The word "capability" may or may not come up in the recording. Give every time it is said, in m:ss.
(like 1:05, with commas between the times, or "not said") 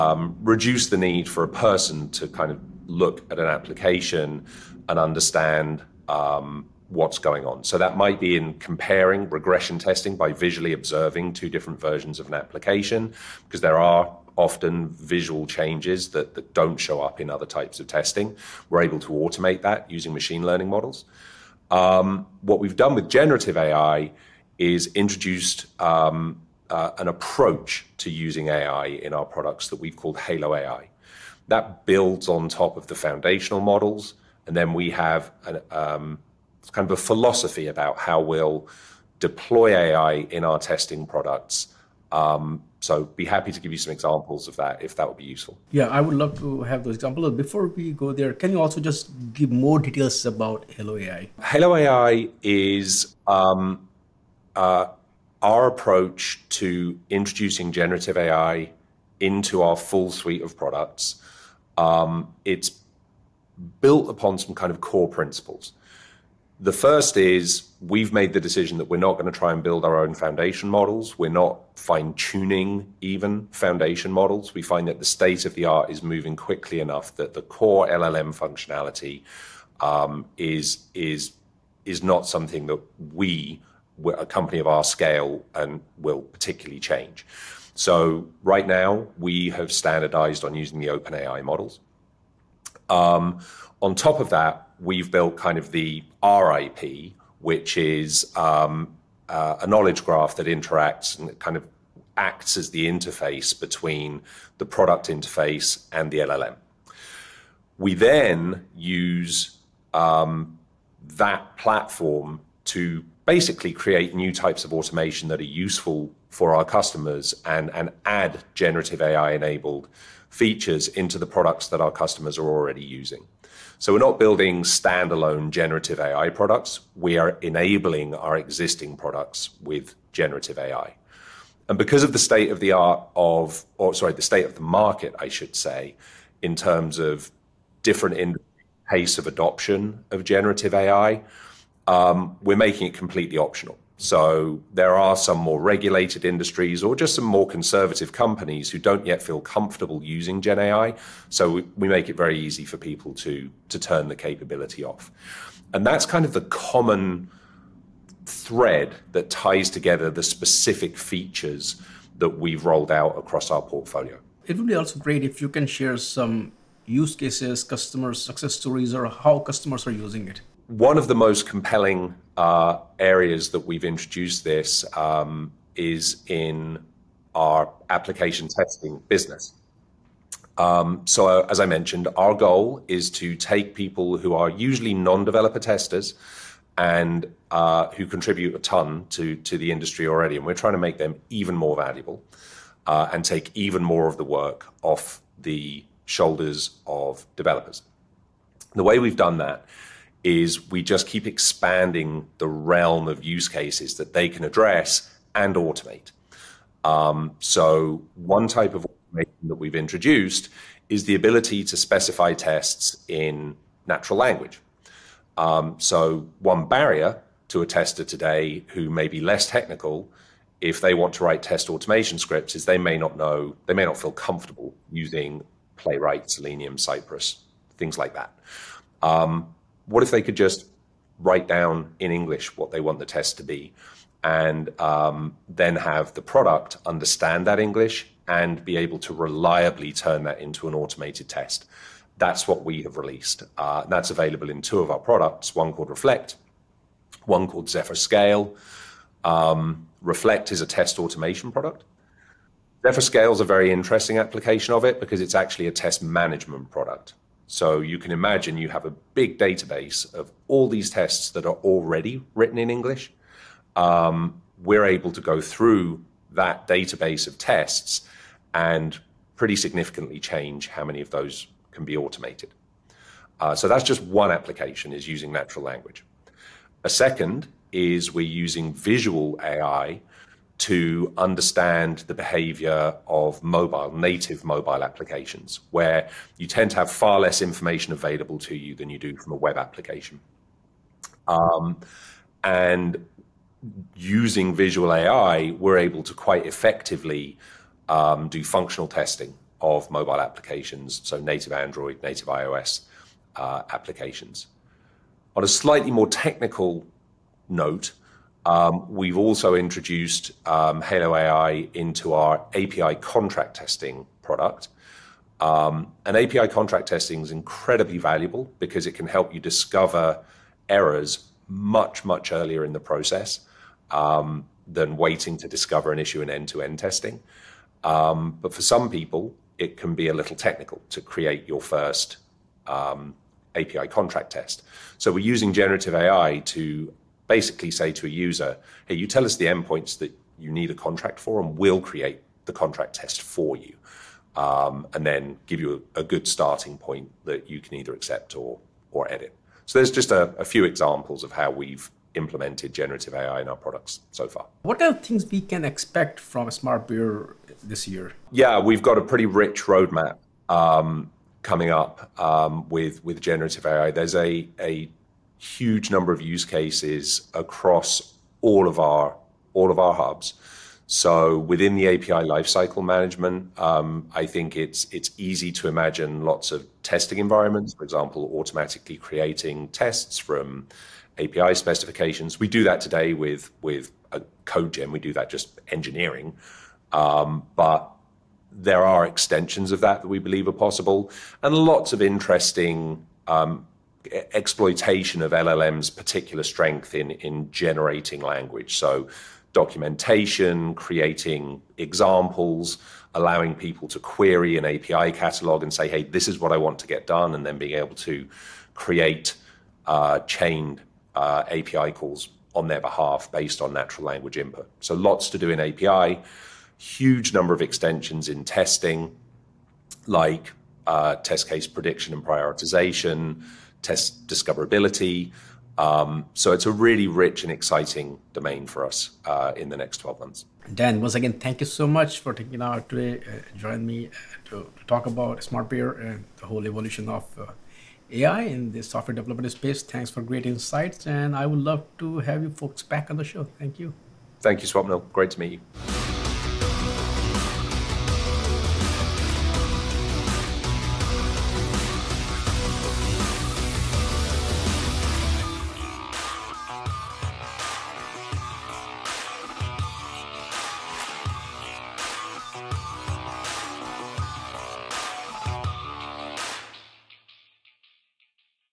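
2:34.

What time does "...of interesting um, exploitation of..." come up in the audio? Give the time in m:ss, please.
6:31.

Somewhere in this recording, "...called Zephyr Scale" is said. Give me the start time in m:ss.
4:07.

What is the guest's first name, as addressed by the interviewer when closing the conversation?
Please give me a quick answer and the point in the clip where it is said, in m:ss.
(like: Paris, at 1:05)
Dan, at 7:10.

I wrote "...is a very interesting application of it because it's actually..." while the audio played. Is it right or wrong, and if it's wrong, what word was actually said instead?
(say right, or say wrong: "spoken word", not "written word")
right.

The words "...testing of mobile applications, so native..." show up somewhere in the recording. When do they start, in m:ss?
4:58.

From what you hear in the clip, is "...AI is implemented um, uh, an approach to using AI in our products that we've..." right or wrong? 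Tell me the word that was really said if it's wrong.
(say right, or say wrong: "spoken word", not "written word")
wrong: "introduced", not "implemented".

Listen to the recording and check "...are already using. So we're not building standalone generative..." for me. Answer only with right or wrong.
right.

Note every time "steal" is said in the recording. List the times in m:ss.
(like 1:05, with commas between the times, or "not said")
not said.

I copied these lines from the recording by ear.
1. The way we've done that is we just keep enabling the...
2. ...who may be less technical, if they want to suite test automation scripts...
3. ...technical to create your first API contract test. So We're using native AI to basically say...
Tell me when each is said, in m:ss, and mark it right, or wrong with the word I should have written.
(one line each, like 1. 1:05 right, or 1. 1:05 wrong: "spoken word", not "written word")
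1. 3:18 wrong: "expanding", not "enabling"
2. 3:38 wrong: "write", not "suite"
3. 5:30 wrong: "generative", not "native".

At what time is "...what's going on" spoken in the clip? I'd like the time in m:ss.
0:06.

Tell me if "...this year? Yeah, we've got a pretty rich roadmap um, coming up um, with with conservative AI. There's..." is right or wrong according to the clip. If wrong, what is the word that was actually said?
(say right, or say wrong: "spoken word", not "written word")
wrong: "generative", not "conservative".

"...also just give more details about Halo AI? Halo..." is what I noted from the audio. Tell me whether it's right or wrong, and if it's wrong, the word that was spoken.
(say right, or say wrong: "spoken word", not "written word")
right.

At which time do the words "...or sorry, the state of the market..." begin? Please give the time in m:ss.
2:13.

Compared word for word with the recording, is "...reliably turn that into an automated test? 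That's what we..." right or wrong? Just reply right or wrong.
right.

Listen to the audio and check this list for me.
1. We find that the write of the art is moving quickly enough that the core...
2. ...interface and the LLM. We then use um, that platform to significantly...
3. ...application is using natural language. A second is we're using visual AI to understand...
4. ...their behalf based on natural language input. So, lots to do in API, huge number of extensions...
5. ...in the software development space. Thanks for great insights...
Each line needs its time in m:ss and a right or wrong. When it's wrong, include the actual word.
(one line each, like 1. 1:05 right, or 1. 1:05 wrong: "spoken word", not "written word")
1. 1:14 wrong: "state", not "write"
2. 1:45 wrong: "basically", not "significantly"
3. 4:34 right
4. 6:52 right
5. 7:18 right.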